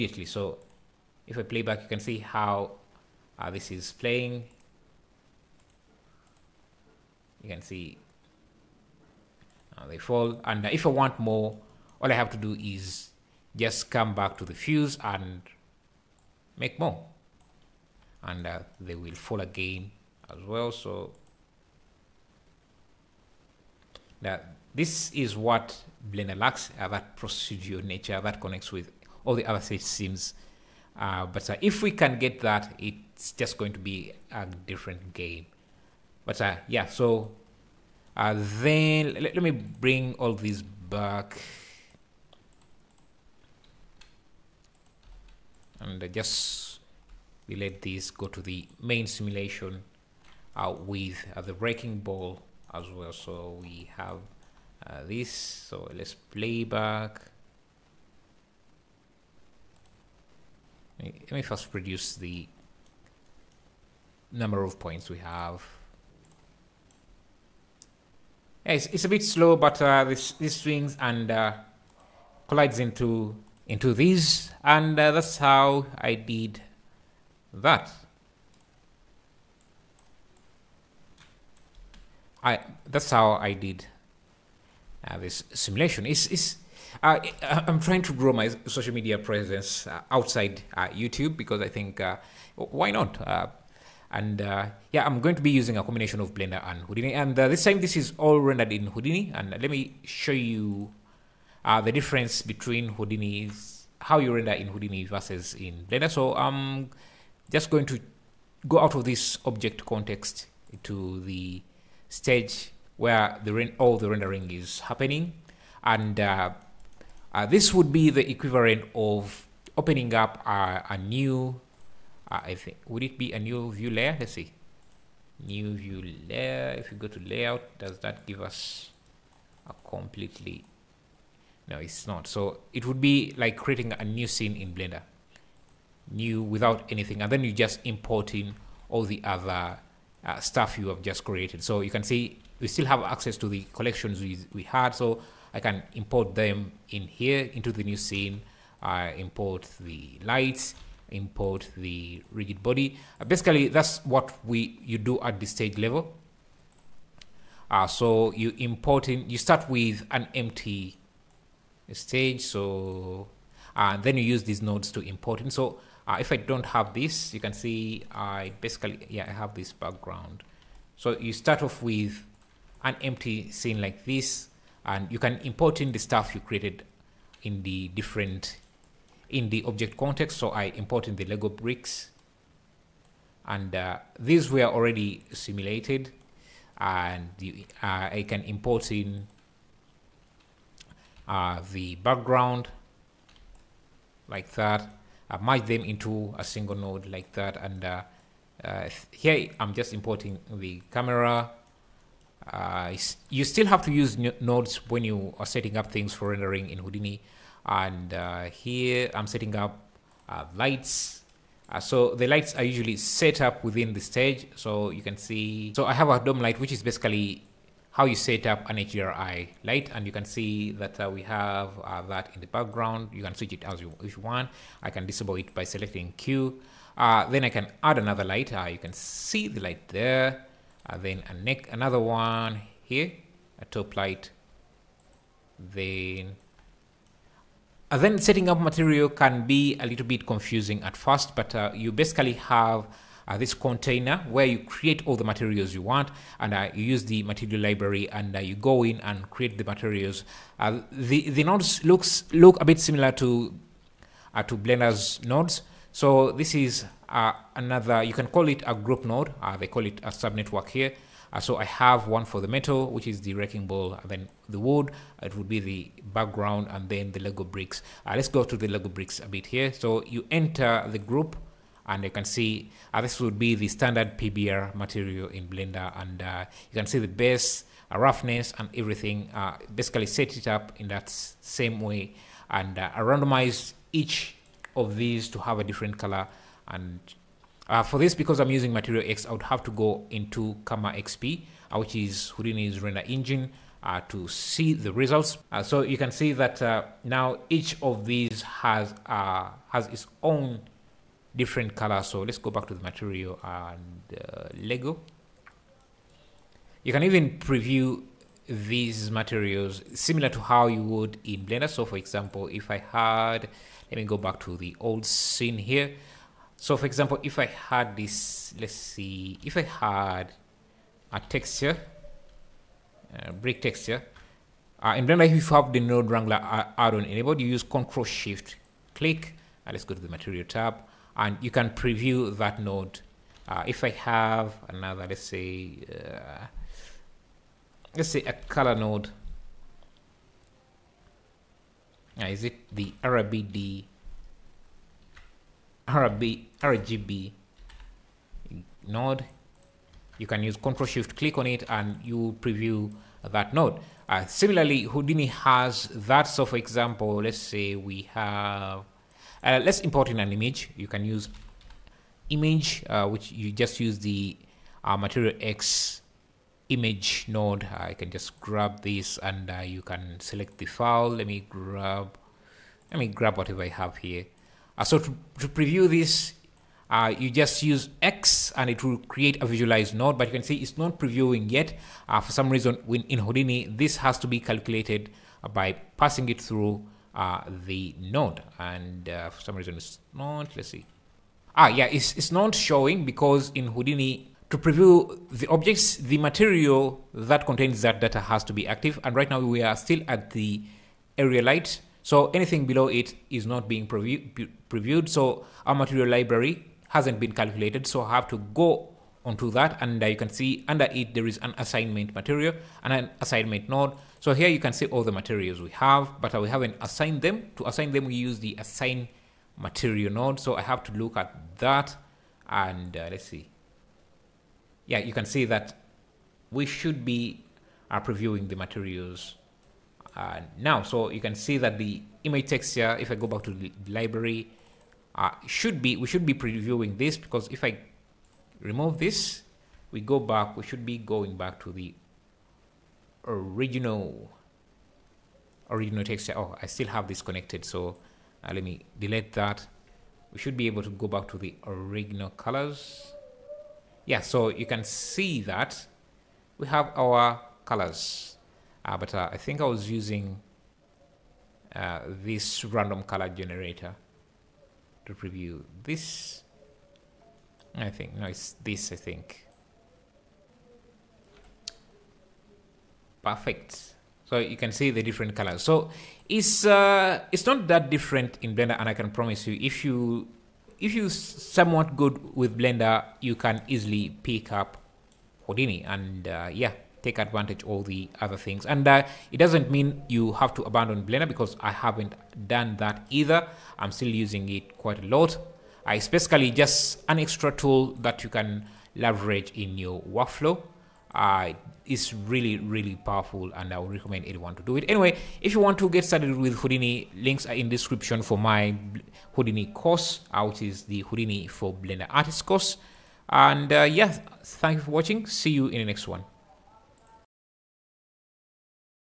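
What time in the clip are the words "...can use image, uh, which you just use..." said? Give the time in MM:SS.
06:00.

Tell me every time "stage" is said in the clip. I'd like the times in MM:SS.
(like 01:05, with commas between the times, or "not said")
01:52, 02:35, 02:41, 03:33.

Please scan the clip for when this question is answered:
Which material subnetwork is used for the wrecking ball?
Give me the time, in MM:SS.
04:22.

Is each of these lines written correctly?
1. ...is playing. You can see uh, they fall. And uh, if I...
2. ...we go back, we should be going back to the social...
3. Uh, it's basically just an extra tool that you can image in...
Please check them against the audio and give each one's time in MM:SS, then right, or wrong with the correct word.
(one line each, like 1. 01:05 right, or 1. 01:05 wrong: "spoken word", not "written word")
1. 00:03 right
2. 07:19 wrong: "original", not "social"
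3. 08:15 wrong: "leverage", not "image".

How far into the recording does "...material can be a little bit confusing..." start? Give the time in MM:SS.
03:58.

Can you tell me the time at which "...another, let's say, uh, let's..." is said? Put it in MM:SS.
05:34.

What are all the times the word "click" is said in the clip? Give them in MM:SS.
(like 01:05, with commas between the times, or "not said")
05:28, 05:51.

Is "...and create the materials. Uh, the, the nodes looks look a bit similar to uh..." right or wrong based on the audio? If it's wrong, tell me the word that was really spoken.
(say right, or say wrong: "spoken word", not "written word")
right.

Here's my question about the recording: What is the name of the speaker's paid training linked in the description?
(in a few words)
Houdini for Blender Artist.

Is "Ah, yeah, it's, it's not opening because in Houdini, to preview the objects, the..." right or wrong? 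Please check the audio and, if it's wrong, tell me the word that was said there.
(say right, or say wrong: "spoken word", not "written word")
wrong: "showing", not "opening".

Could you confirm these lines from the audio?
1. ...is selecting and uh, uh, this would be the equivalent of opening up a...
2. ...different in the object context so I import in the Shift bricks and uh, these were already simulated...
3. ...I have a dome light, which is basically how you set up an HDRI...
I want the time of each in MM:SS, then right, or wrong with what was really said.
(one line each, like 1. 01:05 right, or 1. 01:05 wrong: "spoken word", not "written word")
1. 01:54 wrong: "happening", not "selecting"
2. 02:57 wrong: "Lego", not "Shift"
3. 03:35 right.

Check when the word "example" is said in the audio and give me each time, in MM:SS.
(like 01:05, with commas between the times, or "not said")
05:11, 05:16, 05:56.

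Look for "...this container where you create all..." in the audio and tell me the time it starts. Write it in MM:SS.
04:03.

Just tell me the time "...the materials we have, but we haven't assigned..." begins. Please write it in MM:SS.
06:55.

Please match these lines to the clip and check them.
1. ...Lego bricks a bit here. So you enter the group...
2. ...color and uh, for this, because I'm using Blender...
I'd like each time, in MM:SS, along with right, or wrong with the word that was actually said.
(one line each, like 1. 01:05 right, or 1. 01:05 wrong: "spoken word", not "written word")
1. 04:28 right
2. 04:45 wrong: "Material", not "Blender".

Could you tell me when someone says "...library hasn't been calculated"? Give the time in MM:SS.
06:46.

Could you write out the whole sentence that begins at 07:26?
Oh, I still have this connected, so uh, let me delete that.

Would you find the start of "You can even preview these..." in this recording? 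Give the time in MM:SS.
05:06.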